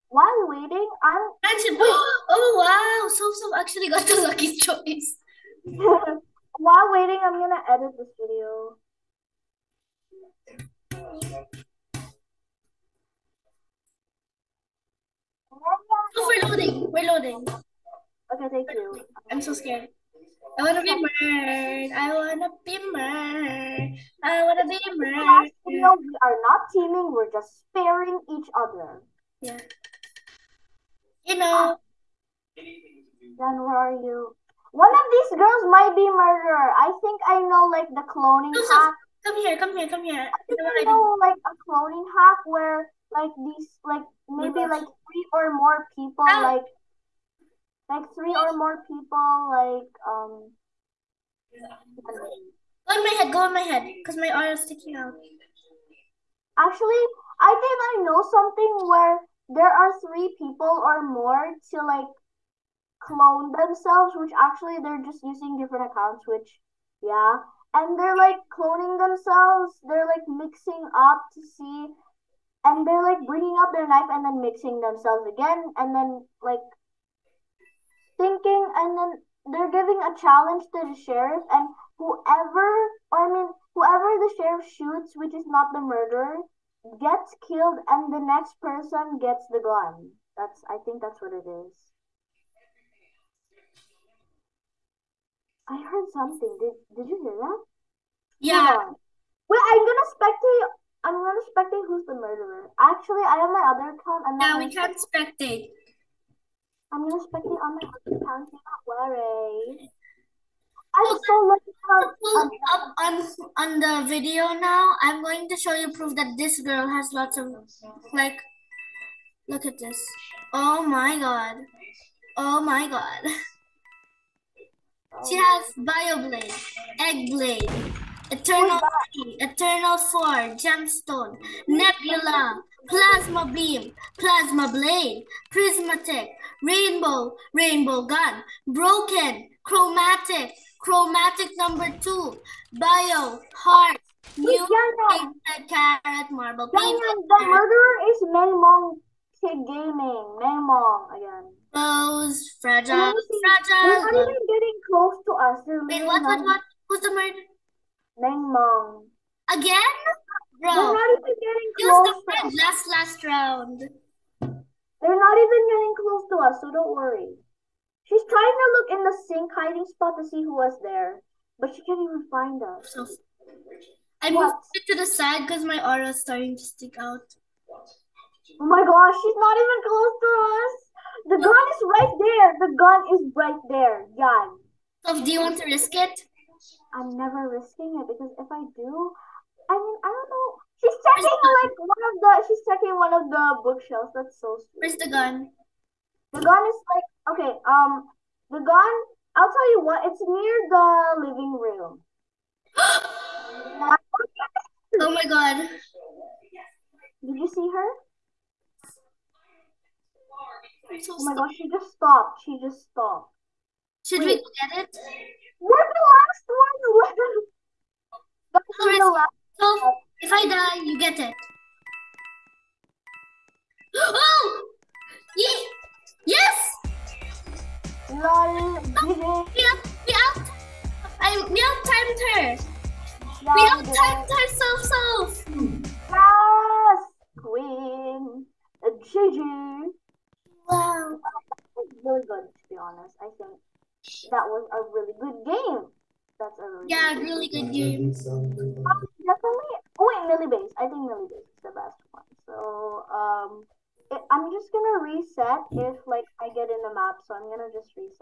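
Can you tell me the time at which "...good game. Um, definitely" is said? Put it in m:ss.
4:07.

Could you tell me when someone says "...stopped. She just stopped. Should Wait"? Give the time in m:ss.
3:31.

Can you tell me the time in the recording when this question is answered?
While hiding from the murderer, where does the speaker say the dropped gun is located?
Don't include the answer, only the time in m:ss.
3:20.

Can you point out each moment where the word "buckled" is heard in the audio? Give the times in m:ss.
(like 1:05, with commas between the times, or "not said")
not said.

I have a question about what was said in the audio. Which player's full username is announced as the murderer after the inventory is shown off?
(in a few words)
Mengmong Gaming.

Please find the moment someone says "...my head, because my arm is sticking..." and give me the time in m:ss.
0:53.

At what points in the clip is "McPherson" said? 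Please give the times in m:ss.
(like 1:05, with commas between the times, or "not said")
not said.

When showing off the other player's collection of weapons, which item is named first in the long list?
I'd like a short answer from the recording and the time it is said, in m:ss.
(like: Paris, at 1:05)
Bio Blade, at 2:05.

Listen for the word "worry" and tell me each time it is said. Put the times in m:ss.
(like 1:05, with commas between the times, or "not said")
1:48, 2:46.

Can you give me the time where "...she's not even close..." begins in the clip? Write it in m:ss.
2:59.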